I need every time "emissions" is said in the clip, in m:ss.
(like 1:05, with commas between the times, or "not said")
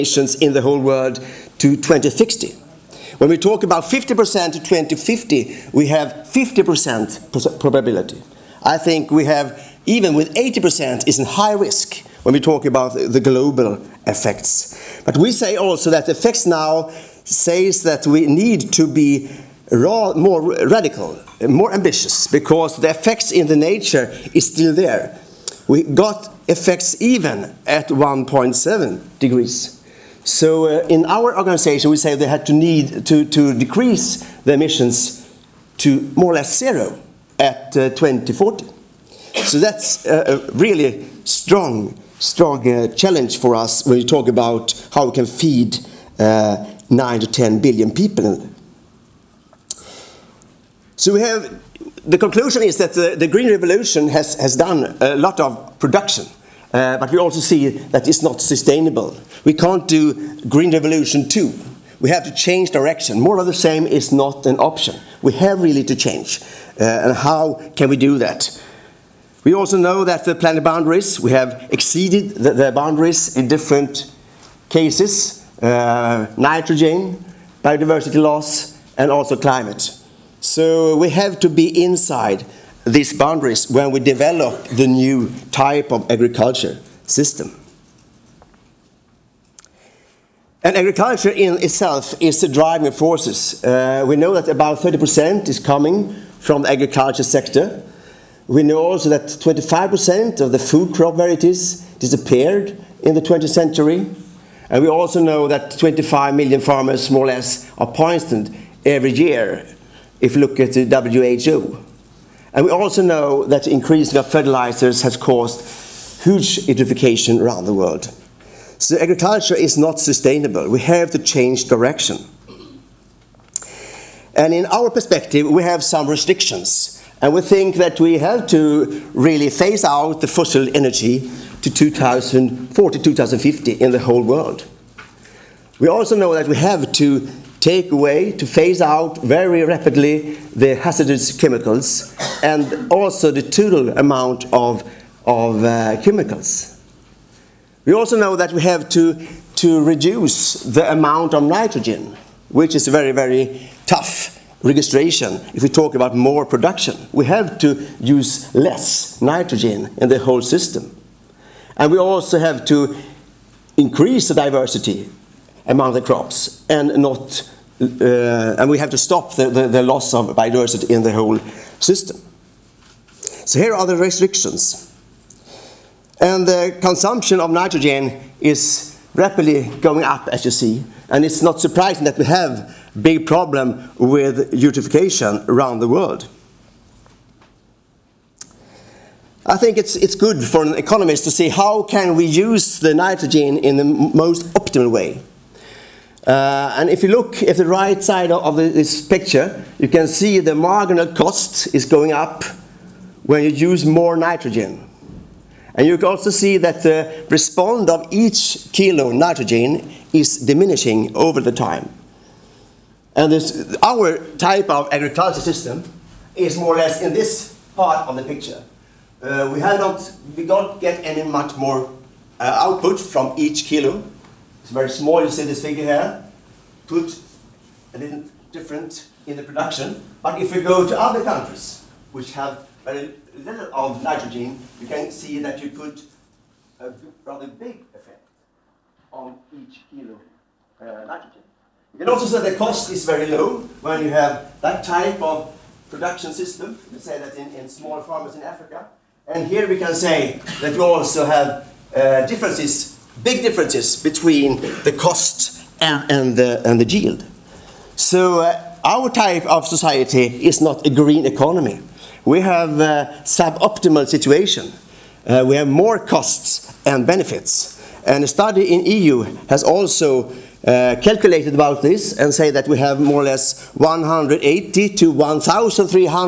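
0:34.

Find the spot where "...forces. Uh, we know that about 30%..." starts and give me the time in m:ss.
1:32.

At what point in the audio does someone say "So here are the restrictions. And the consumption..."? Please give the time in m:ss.
2:53.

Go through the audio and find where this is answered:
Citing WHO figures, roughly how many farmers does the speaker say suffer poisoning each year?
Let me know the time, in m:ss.
1:45.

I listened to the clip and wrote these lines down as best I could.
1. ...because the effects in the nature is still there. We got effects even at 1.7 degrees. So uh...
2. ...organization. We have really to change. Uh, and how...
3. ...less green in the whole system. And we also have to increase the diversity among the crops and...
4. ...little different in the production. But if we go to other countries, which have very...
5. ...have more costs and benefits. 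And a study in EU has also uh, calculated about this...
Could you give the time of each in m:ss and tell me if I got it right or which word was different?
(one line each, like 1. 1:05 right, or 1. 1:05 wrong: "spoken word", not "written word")
1. 0:22 right
2. 1:04 wrong: "option", not "organization"
3. 2:38 wrong: "nitrogen", not "green"
4. 3:47 right
5. 4:25 right.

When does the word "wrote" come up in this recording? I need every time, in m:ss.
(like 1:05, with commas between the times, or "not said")
not said.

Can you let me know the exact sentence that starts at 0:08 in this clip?
I think we have, even with 80%, is in high risk when we talk about the global effects.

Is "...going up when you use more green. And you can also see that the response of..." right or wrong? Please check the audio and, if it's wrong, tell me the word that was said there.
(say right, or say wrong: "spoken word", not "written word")
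wrong: "nitrogen", not "green".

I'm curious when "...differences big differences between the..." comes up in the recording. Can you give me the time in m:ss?
4:12.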